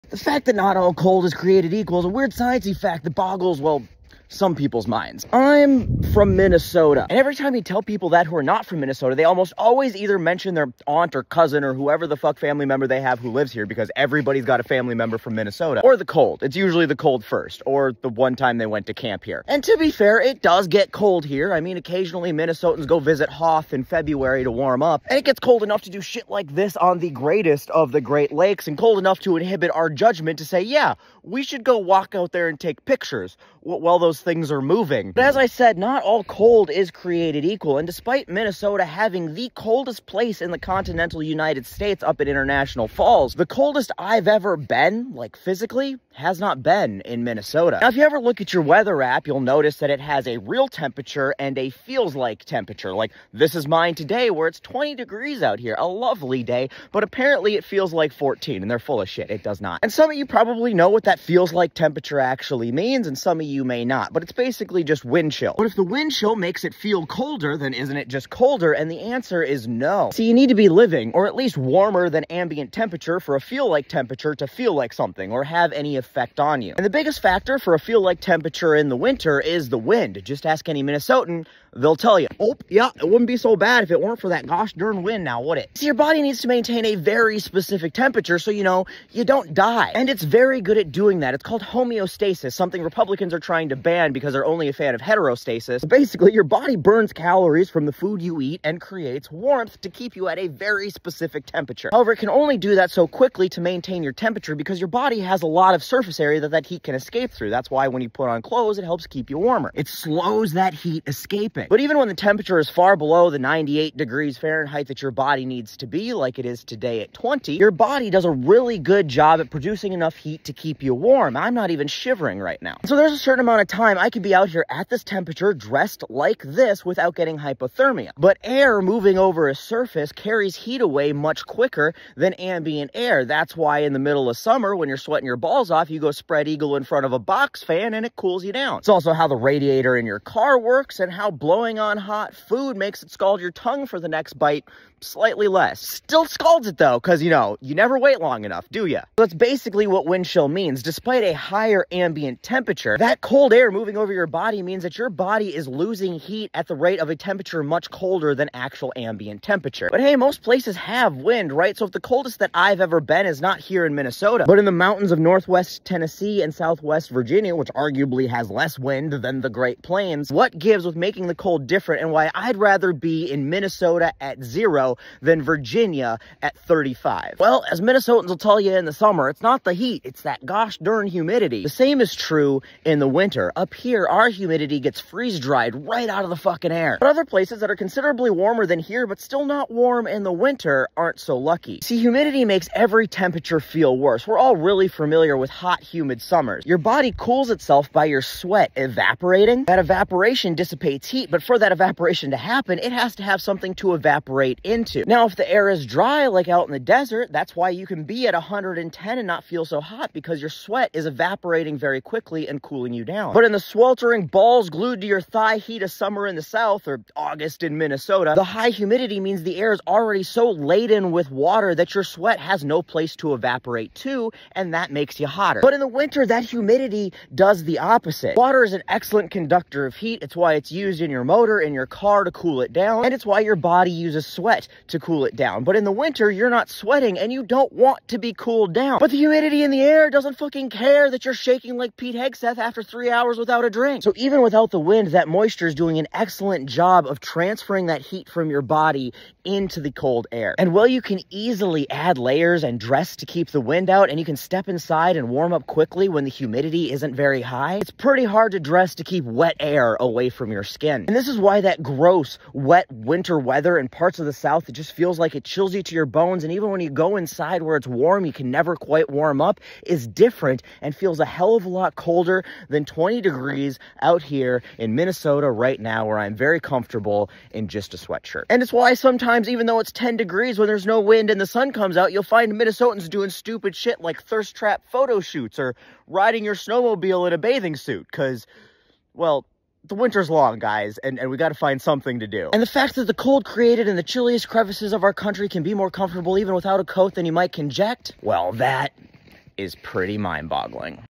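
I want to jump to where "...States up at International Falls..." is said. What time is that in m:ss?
0:41.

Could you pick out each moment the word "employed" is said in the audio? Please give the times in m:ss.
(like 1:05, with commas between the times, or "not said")
not said.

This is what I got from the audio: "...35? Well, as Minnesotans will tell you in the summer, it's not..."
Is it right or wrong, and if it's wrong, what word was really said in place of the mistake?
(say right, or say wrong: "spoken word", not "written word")
right.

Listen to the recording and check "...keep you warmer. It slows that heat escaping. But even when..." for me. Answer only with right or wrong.
right.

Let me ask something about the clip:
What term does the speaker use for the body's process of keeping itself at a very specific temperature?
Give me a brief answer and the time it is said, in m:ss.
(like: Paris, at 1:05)
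homeostasis, at 1:31.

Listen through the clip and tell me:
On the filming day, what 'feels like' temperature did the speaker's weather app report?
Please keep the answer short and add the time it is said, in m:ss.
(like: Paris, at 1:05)
14, at 0:58.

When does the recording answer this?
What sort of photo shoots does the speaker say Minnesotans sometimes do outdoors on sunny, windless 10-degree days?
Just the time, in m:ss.
4:44.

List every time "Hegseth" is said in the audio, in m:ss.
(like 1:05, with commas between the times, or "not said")
4:02.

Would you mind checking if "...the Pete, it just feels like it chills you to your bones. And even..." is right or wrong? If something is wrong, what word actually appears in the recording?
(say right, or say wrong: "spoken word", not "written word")
wrong: "South", not "Pete".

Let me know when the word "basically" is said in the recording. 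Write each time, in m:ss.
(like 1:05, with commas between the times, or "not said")
1:04, 1:35, 2:29.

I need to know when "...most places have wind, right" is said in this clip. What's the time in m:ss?
2:40.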